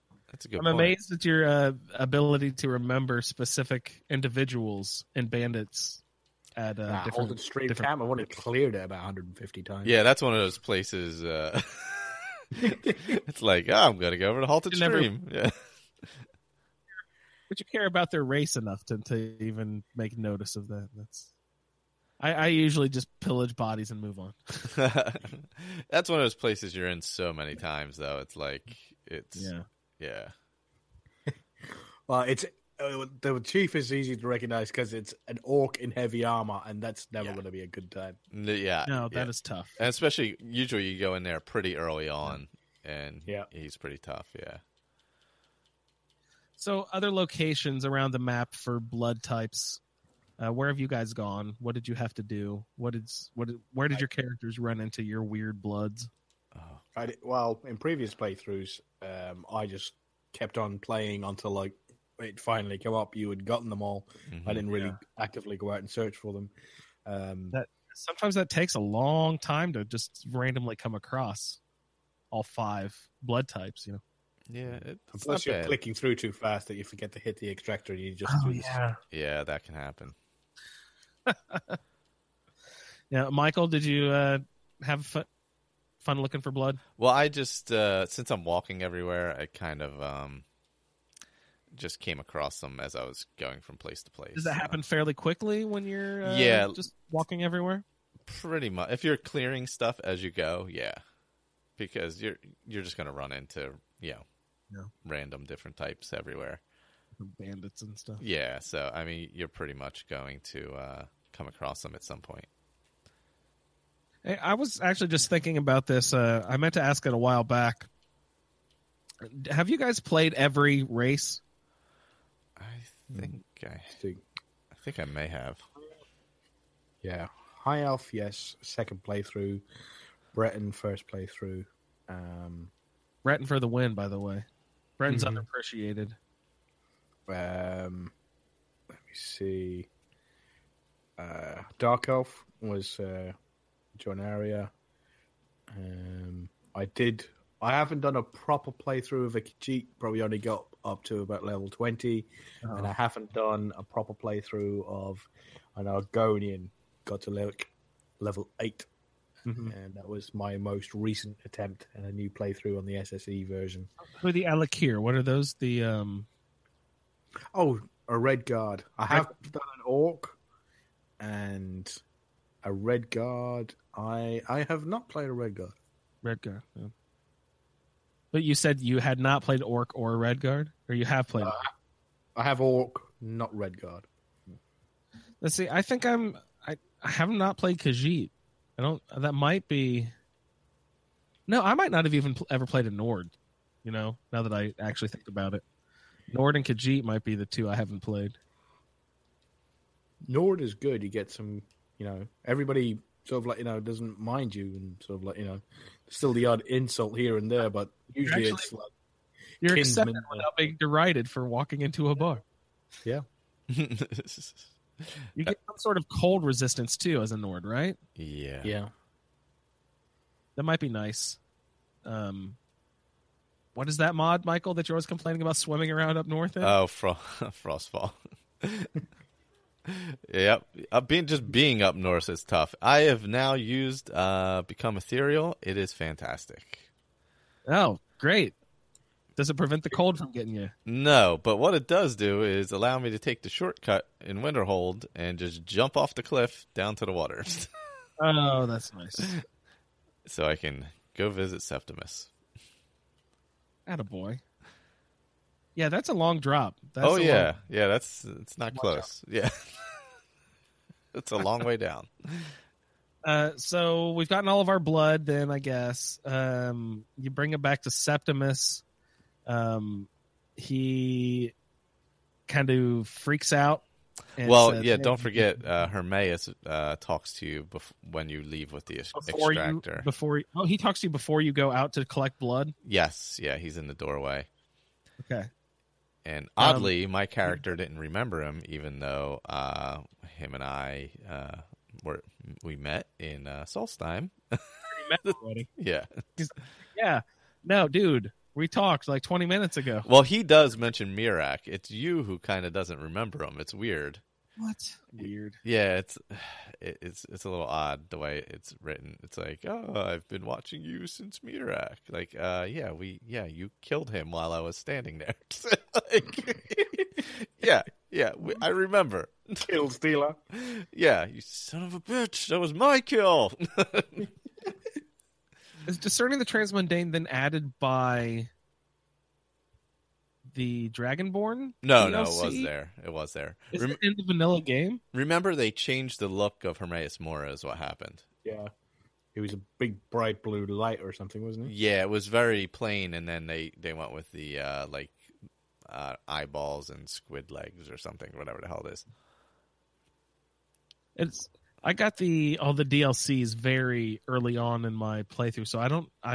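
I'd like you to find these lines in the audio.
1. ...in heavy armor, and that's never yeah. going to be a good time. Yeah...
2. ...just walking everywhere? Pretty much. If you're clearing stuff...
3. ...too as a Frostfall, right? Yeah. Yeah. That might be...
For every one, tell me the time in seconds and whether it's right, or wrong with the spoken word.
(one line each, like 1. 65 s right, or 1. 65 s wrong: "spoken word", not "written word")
1. 35 s right
2. 96 s right
3. 216 s wrong: "Nord", not "Frostfall".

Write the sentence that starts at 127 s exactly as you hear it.
Yeah, High Elf, yes, second playthrough.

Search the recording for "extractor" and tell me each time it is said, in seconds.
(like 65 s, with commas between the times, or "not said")
77 s, 279 s.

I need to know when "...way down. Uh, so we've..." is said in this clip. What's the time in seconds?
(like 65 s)
261 s.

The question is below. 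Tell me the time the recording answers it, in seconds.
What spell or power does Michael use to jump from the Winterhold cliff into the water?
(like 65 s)
234 s.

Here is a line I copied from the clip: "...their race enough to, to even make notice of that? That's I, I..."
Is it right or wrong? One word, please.
right.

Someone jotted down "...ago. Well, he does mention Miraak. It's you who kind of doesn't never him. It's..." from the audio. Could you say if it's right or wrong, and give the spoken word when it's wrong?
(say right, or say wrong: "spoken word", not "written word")
wrong: "remember", not "never".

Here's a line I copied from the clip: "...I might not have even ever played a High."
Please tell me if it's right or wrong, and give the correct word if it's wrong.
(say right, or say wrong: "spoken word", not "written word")
wrong: "Nord", not "High".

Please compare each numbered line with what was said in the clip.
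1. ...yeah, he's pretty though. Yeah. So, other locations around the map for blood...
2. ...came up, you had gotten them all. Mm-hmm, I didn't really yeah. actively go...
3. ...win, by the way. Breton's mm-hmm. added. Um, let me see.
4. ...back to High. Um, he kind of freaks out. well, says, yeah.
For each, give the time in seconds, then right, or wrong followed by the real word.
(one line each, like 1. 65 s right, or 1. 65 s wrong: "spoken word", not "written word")
1. 43 s wrong: "tough", not "though"
2. 62 s right
3. 133 s wrong: "underappreciated", not "added"
4. 267 s wrong: "Septimus", not "High".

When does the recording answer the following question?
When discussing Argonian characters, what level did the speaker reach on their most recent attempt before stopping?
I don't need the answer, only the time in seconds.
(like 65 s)
158 s.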